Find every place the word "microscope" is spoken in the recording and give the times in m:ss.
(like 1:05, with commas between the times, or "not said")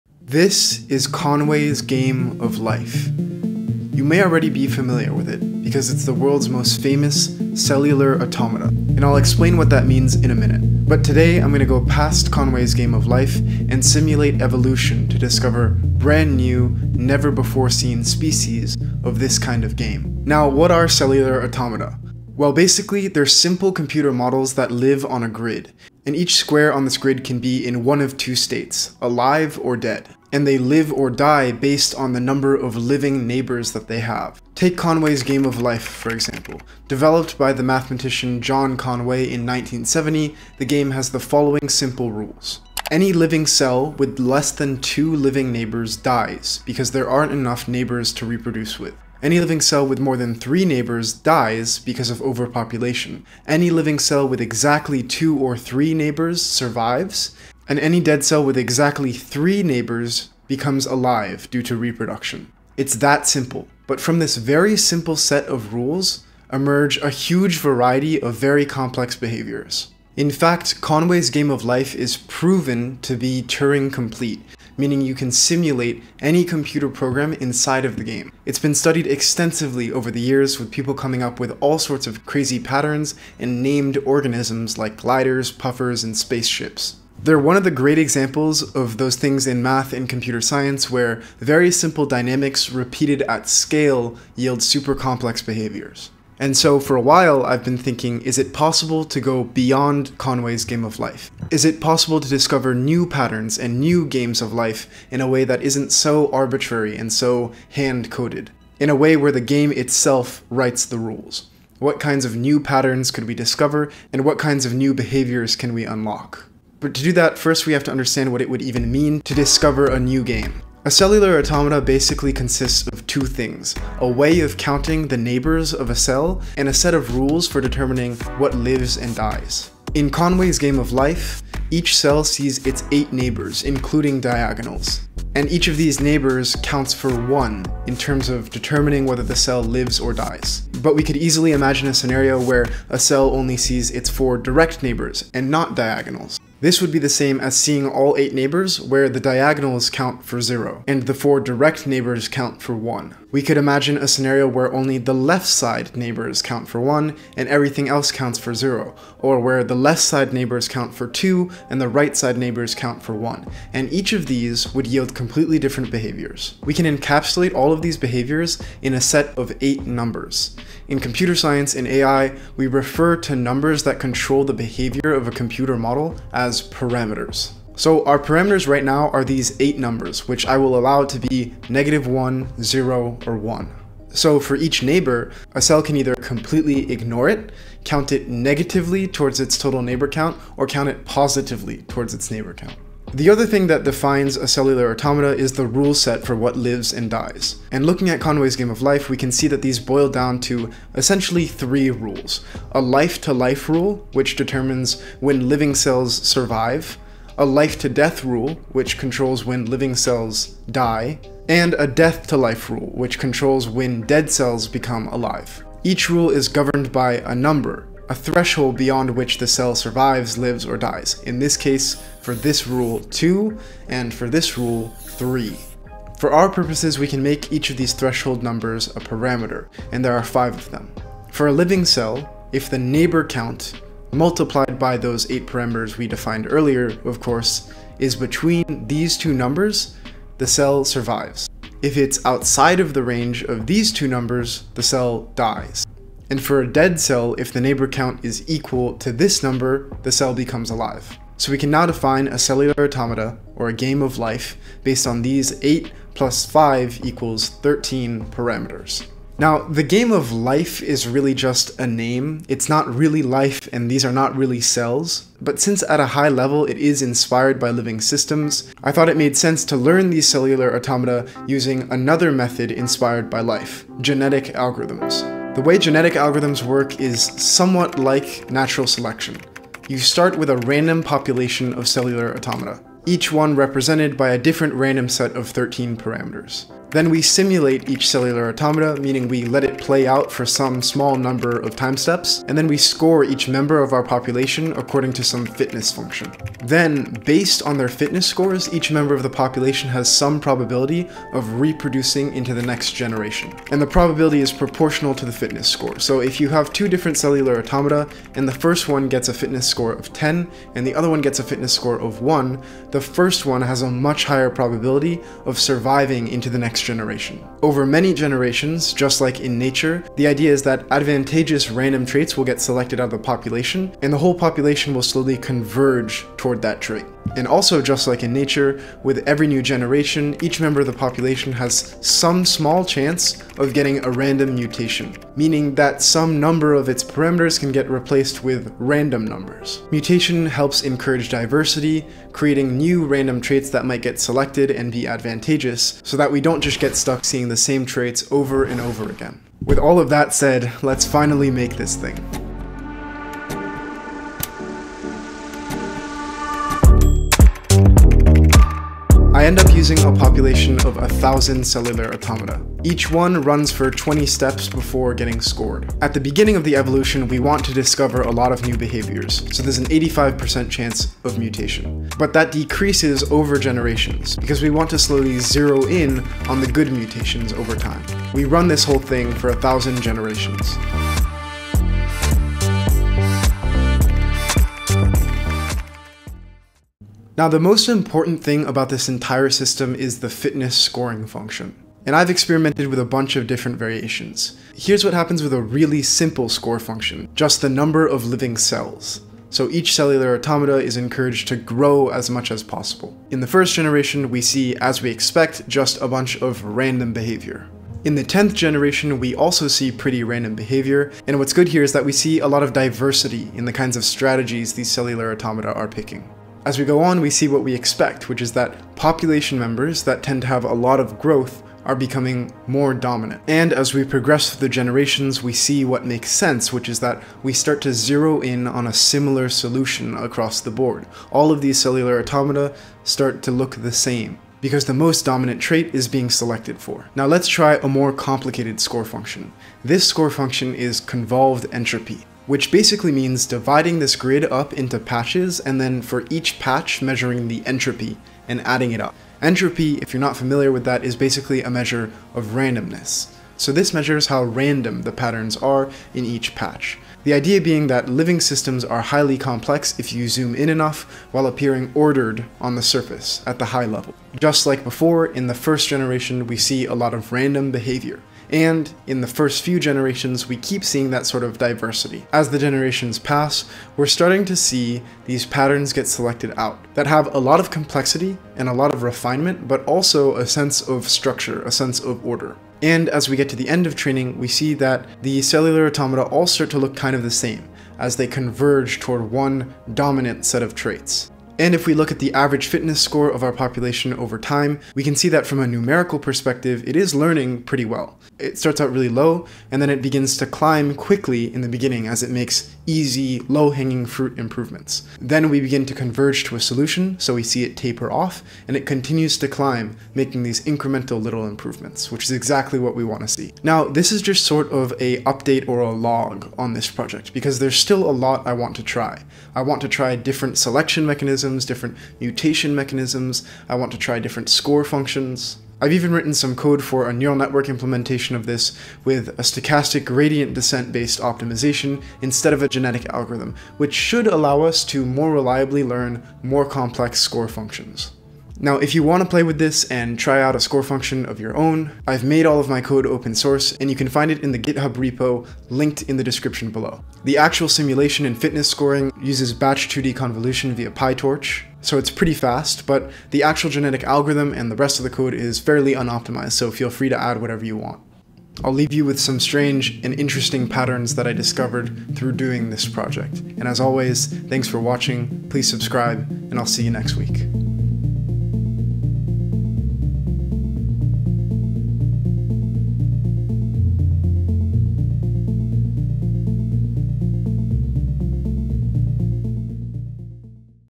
not said.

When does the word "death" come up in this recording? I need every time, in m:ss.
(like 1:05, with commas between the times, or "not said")
3:27, 3:31.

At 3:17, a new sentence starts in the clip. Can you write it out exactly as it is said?
And looking at Conway's Game of Life, we can see that these boil down to essentially three rules.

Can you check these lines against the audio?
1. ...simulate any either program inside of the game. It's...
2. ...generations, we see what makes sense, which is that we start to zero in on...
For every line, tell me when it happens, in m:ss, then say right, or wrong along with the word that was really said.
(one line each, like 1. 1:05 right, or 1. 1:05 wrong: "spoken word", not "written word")
1. 1:15 wrong: "computer", not "either"
2. 7:04 right.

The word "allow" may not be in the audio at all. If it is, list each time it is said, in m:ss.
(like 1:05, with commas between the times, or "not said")
3:00, 8:54.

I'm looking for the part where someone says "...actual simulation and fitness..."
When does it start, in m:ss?
9:07.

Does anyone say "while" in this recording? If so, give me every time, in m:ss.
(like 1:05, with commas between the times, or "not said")
1:37, 7:41.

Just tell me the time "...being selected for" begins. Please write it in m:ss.
7:16.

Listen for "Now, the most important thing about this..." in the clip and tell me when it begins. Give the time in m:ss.
6:27.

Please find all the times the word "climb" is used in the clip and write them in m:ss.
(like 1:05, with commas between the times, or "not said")
8:20, 8:29.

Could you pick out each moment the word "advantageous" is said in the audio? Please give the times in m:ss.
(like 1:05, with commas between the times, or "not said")
5:20, 5:45.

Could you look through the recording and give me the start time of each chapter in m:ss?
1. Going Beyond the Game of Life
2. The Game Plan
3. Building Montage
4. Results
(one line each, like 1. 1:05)
1. 1:26
2. 2:00
3. 5:43
4. 6:26.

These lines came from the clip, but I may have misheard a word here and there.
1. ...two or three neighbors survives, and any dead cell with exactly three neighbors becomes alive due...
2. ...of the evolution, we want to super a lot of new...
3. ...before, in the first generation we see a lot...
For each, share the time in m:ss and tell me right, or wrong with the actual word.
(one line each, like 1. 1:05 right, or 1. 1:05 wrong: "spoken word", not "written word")
1. 0:55 right
2. 6:06 wrong: "discover", not "super"
3. 7:44 right.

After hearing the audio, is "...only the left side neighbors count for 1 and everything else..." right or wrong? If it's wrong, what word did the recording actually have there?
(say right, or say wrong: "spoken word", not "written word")
right.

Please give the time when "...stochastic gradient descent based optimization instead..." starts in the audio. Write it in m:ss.
8:49.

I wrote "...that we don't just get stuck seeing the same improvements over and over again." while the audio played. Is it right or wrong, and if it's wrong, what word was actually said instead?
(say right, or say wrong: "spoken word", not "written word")
wrong: "traits", not "improvements".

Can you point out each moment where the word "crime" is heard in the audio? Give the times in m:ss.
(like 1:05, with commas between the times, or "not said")
not said.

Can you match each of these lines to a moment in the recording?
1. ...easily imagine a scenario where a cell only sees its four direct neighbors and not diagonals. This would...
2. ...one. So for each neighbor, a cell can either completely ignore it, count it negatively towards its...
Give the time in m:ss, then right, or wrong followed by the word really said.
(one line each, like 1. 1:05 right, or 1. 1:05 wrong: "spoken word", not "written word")
1. 2:21 right
2. 3:03 right.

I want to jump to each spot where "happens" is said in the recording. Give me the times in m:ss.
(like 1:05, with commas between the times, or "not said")
6:35.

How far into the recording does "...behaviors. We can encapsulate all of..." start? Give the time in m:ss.
2:45.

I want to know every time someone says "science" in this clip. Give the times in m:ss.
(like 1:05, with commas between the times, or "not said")
1:30, 2:51.